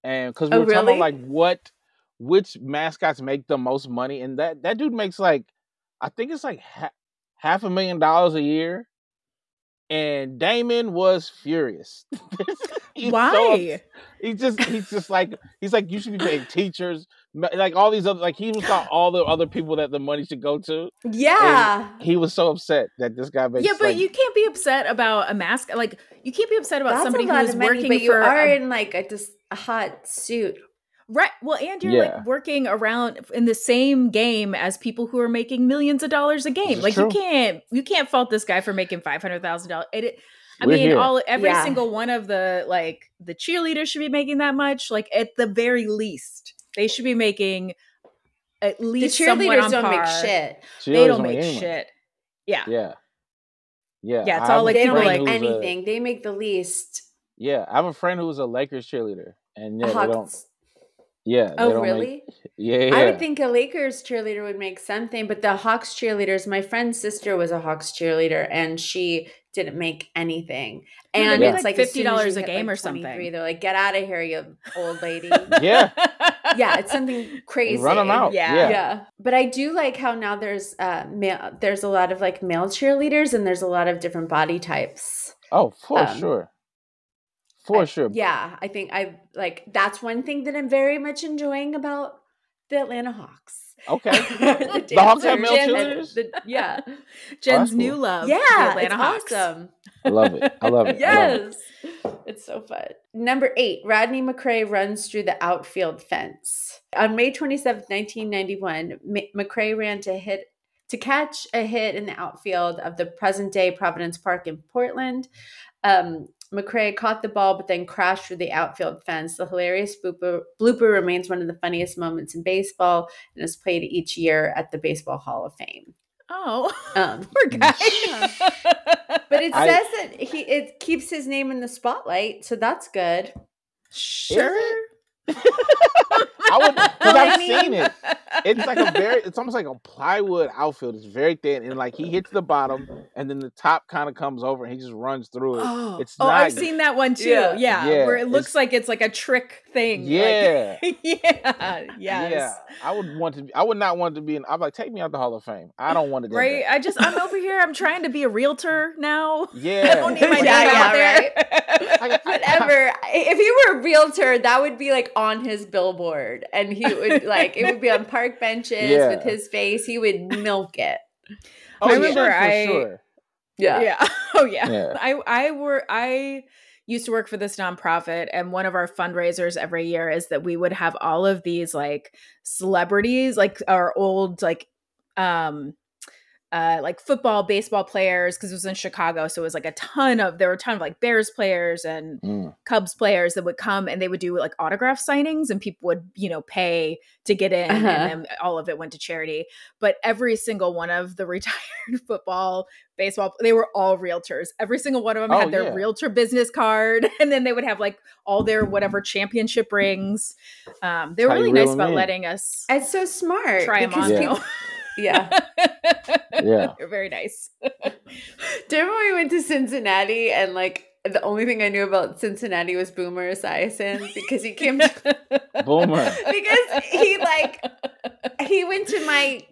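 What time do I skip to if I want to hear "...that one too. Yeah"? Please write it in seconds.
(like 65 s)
146 s.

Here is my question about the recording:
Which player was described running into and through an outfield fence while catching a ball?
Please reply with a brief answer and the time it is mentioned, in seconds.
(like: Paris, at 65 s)
Rodney McCray, at 103 s.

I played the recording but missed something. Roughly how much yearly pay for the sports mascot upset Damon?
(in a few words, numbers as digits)
half a million dollars.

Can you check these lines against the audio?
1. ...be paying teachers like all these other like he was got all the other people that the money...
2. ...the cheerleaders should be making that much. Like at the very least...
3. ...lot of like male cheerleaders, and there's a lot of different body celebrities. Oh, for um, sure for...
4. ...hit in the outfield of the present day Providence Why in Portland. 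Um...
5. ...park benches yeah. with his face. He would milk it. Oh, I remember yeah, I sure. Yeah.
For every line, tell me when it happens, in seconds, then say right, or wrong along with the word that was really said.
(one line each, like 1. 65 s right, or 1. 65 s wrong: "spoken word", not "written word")
1. 16 s right
2. 43 s right
3. 81 s wrong: "types", not "celebrities"
4. 111 s wrong: "Park", not "Why"
5. 168 s right.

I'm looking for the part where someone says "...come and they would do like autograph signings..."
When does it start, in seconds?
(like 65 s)
193 s.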